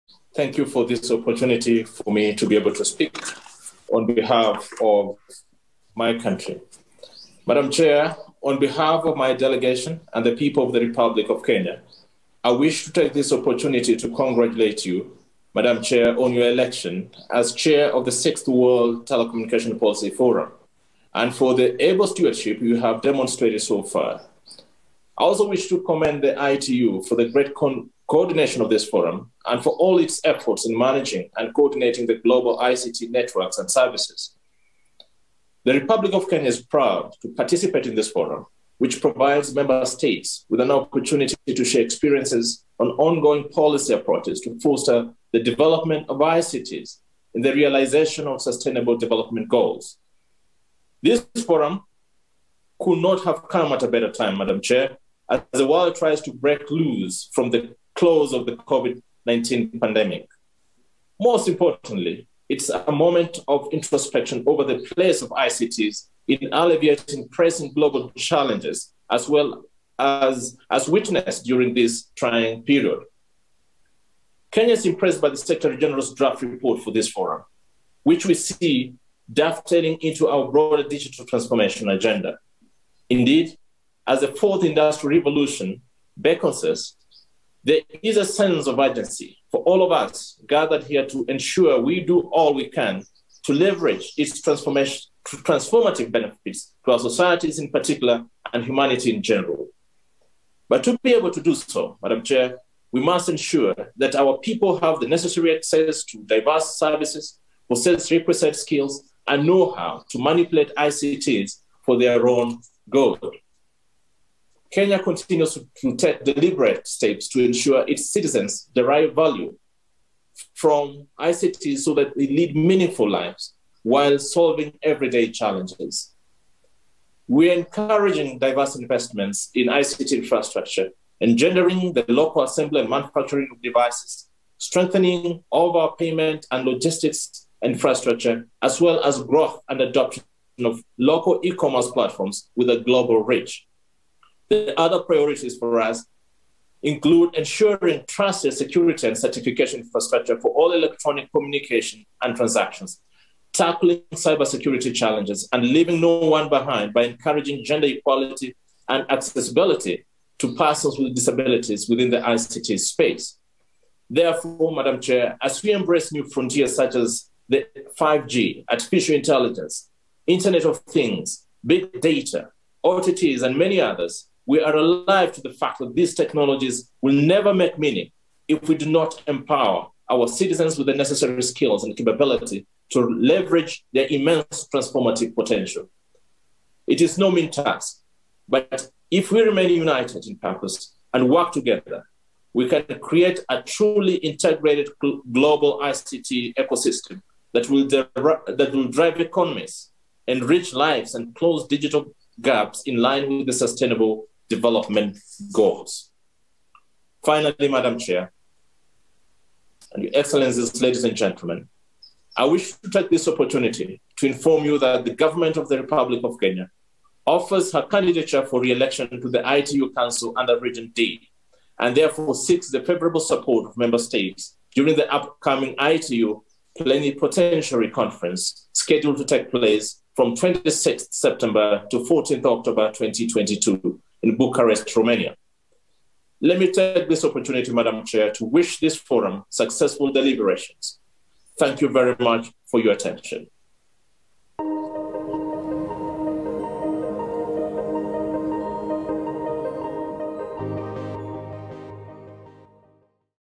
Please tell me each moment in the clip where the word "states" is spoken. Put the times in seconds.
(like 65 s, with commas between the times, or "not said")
39 s, 224 s.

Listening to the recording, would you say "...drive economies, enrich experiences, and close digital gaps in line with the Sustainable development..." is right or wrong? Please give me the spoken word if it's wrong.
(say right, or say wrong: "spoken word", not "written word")
wrong: "lives", not "experiences".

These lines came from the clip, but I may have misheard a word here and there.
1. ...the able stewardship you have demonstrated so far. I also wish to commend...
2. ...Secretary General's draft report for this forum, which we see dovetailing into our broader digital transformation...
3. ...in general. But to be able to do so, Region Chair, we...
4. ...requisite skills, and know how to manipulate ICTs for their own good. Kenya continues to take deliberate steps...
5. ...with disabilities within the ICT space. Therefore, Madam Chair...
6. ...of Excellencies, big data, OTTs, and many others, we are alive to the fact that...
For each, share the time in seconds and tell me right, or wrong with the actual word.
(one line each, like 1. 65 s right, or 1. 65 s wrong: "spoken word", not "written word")
1. 21 s right
2. 75 s right
3. 99 s wrong: "Madam", not "Region"
4. 108 s right
5. 160 s right
6. 170 s wrong: "Things", not "Excellencies".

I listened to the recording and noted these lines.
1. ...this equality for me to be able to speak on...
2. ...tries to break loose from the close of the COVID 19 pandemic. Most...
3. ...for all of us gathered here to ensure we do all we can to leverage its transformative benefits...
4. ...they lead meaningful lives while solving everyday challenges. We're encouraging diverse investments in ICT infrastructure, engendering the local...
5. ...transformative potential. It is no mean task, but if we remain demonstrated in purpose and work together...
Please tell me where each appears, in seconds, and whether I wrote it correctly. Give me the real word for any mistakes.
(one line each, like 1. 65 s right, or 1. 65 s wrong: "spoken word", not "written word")
1. 0 s wrong: "opportunity", not "equality"
2. 55 s right
3. 89 s right
4. 122 s right
5. 184 s wrong: "united", not "demonstrated".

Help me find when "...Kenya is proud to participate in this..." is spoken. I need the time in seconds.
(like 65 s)
36 s.